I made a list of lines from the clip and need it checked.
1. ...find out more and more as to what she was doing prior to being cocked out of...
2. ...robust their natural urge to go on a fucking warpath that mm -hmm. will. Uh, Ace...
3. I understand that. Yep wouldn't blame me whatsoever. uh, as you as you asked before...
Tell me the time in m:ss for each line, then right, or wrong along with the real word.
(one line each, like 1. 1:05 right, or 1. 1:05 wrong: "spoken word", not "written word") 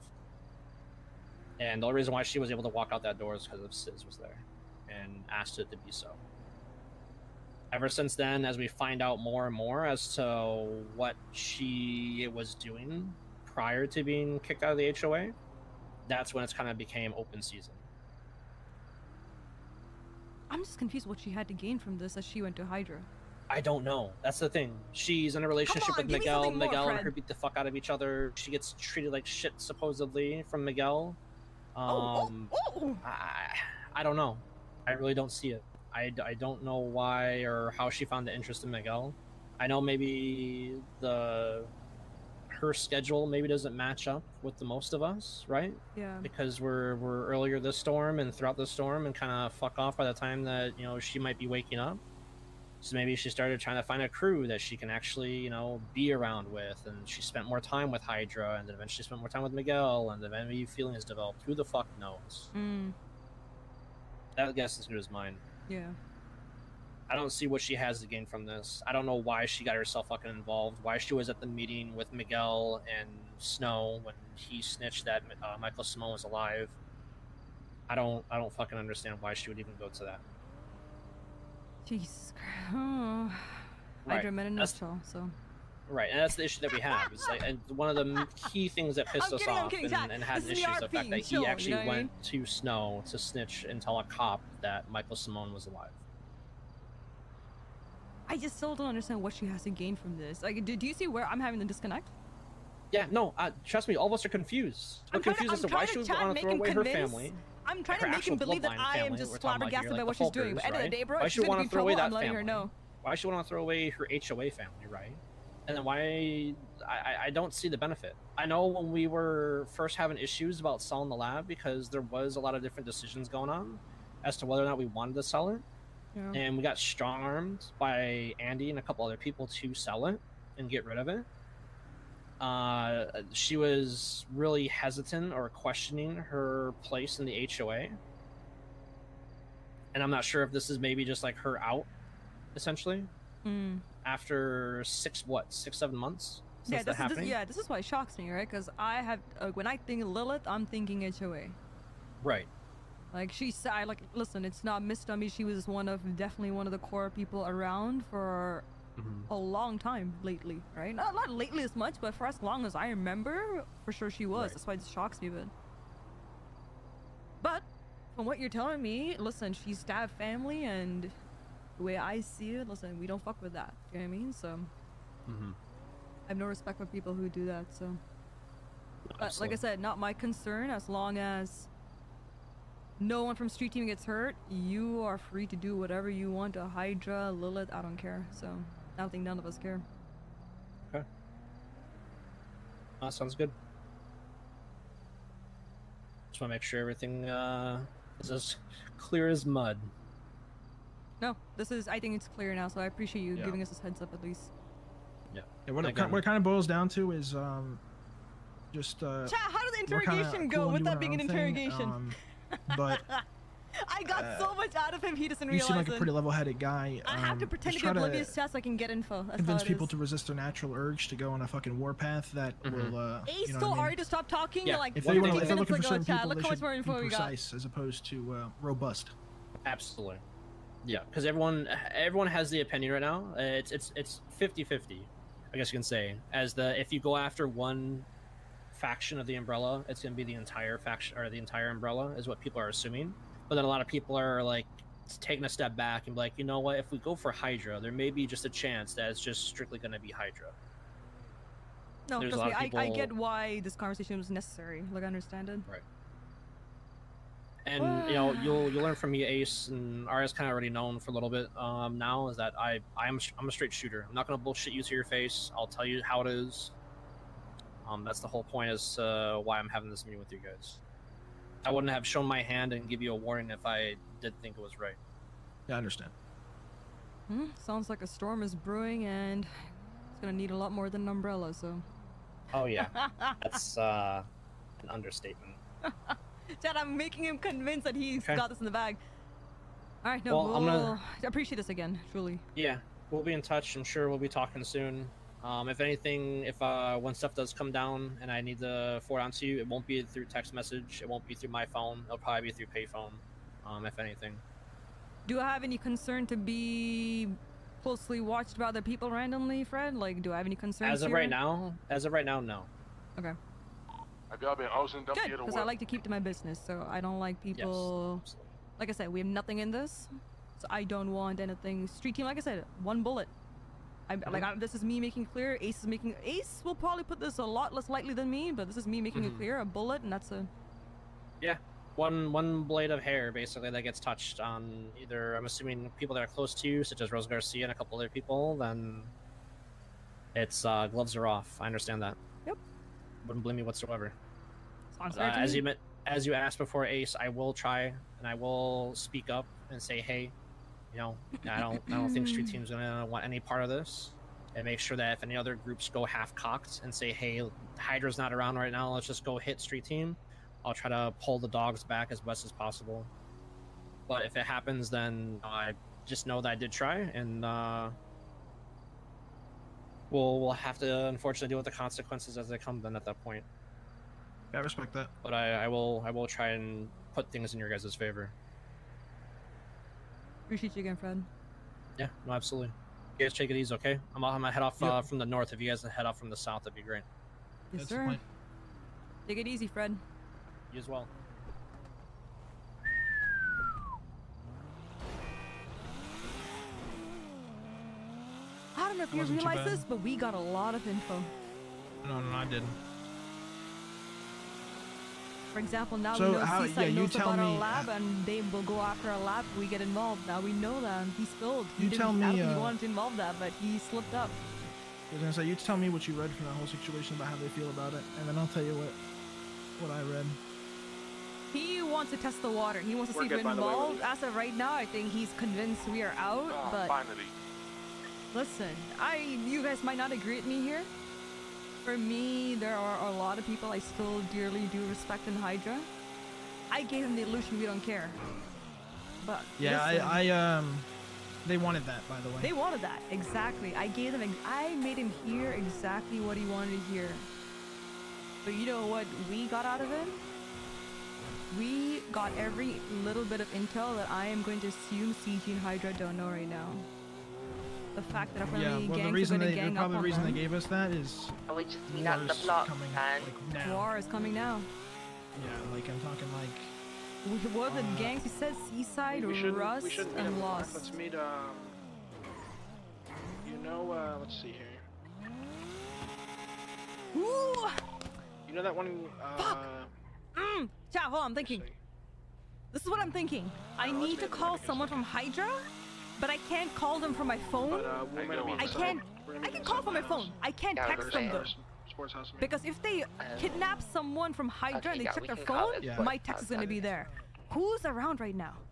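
1. 0:08 wrong: "kicked", not "cocked"
2. 3:39 wrong: "resist", not "robust"
3. 5:41 right.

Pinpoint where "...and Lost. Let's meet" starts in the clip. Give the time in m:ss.
7:50.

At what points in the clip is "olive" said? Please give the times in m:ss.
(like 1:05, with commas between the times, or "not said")
not said.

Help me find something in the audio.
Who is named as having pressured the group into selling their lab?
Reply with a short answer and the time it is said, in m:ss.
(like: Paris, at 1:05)
Andy, at 2:08.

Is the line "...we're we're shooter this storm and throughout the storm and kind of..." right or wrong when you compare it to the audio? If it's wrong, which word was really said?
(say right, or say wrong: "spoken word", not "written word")
wrong: "earlier", not "shooter".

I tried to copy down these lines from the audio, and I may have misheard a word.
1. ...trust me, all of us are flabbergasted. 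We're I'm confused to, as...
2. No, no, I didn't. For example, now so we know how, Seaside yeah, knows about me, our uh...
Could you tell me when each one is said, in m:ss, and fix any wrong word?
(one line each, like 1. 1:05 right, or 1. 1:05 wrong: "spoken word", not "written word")
1. 1:43 wrong: "confused", not "flabbergasted"
2. 6:42 right.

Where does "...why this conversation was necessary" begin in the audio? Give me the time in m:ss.
4:13.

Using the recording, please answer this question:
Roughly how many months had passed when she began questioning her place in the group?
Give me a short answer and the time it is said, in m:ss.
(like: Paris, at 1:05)
6 or 7 months, at 2:25.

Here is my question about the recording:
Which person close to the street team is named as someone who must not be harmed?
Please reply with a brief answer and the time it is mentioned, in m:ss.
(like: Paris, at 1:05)
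Rose Garcia, at 5:37.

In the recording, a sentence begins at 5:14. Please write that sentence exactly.
Good, because I like to keep to my business, so I don't like people...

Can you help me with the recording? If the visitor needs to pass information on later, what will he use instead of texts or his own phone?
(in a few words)
Payphone.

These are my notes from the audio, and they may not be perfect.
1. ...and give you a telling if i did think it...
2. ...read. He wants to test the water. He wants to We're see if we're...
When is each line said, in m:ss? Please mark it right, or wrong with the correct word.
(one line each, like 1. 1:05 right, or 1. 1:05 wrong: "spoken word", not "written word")
1. 4:32 wrong: "warning", not "telling"
2. 7:00 right.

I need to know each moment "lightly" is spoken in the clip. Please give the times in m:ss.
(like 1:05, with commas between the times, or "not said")
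5:27.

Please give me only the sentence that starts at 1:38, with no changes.
I just still don't understand what she has to gain from this.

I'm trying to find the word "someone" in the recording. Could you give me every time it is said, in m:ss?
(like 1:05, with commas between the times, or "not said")
8:04, 8:13.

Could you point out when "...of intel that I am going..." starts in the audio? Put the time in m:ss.
7:33.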